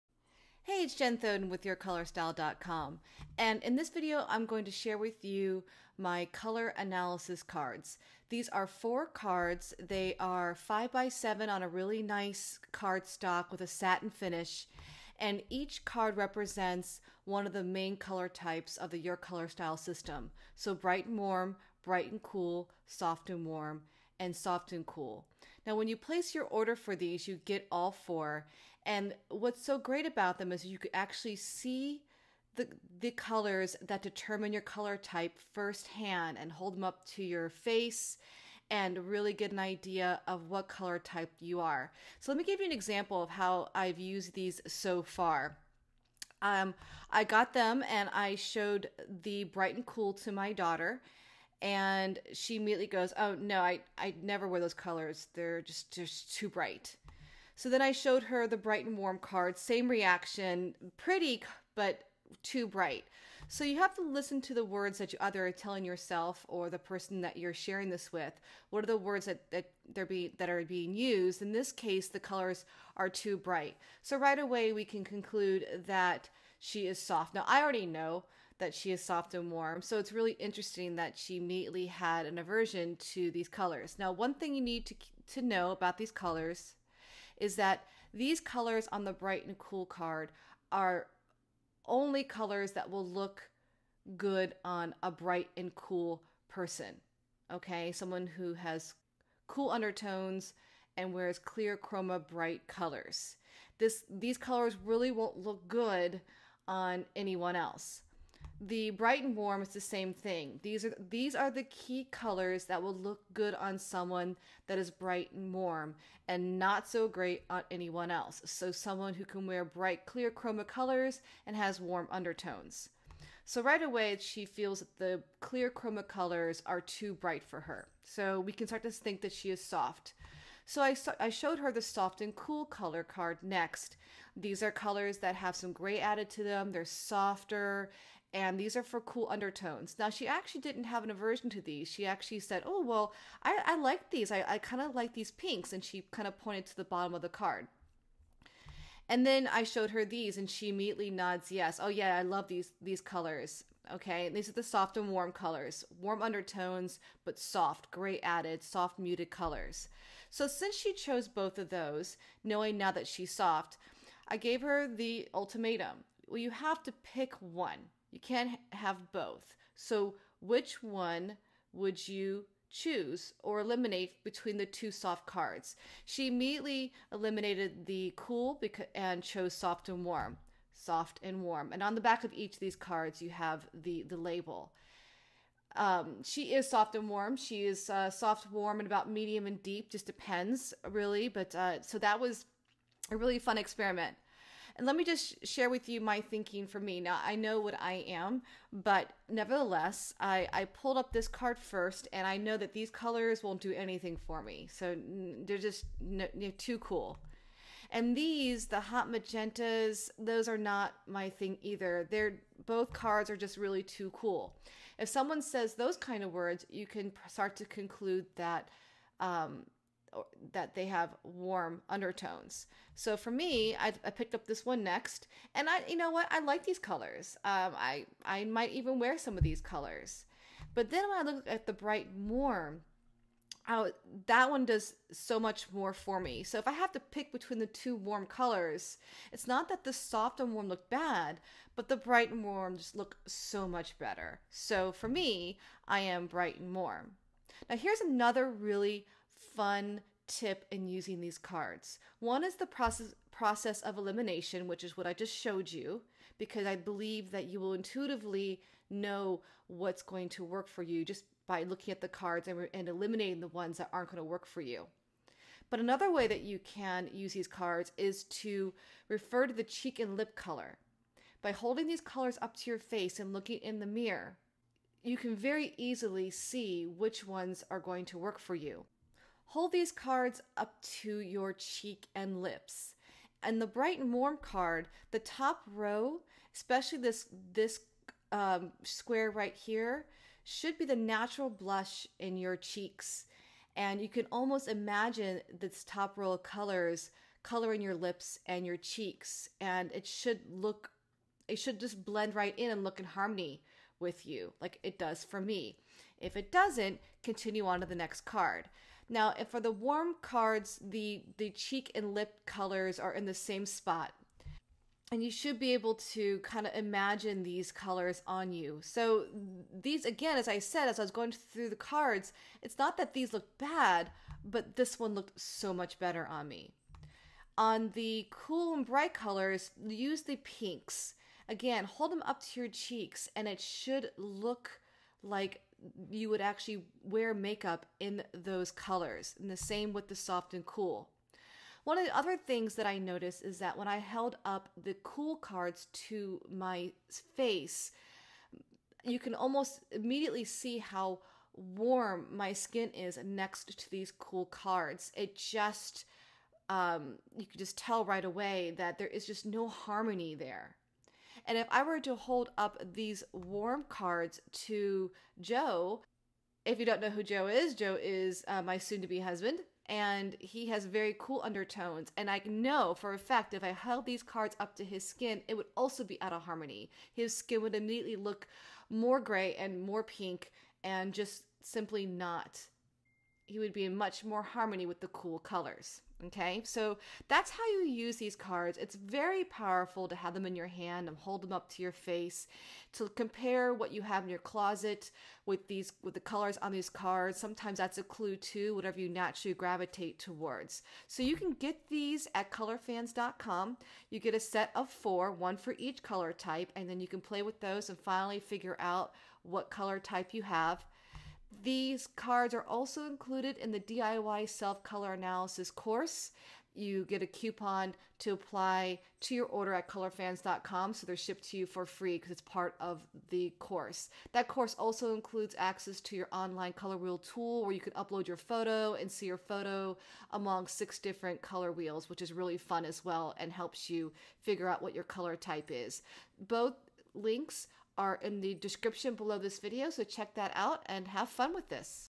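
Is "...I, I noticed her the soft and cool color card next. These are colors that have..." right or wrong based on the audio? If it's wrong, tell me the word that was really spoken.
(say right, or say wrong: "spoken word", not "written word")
wrong: "showed", not "noticed".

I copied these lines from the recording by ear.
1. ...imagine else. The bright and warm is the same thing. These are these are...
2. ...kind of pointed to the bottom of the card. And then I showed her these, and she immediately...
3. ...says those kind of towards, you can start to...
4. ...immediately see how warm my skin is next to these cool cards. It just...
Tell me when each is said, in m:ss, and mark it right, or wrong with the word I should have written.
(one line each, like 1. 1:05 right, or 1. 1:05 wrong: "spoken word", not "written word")
1. 1:47 wrong: "anyone", not "imagine"
2. 2:26 right
3. 3:35 wrong: "words", not "towards"
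4. 5:49 right.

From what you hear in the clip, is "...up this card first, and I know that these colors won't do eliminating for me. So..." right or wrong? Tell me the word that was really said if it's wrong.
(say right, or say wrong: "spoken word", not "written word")
wrong: "anything", not "eliminating".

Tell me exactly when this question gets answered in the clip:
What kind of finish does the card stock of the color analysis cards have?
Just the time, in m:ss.
0:13.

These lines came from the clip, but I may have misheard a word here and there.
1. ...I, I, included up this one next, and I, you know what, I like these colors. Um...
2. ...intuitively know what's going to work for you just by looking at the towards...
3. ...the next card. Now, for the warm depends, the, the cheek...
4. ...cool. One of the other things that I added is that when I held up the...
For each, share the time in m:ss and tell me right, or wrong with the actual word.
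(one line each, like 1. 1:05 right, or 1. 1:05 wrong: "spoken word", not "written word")
1. 3:43 wrong: "picked", not "included"
2. 4:17 wrong: "cards", not "towards"
3. 5:07 wrong: "cards", not "depends"
4. 5:40 wrong: "noticed", not "added".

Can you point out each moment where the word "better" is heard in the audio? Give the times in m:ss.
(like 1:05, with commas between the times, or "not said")
4:03, 5:25.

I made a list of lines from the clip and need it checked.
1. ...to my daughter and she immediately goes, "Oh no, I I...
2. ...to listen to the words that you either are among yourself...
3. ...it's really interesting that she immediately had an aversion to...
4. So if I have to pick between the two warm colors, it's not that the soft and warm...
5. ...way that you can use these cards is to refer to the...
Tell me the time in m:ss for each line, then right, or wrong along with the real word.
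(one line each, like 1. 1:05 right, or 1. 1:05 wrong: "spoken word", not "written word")
1. 0:50 right
2. 1:03 wrong: "telling", not "among"
3. 1:19 right
4. 3:56 right
5. 4:26 right.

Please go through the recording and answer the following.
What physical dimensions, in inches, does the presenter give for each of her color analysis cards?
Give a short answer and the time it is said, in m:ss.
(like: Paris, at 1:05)
5 by 7, at 0:10.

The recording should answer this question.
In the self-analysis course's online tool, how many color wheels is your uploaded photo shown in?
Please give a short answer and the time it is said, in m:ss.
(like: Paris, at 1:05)
6, at 7:10.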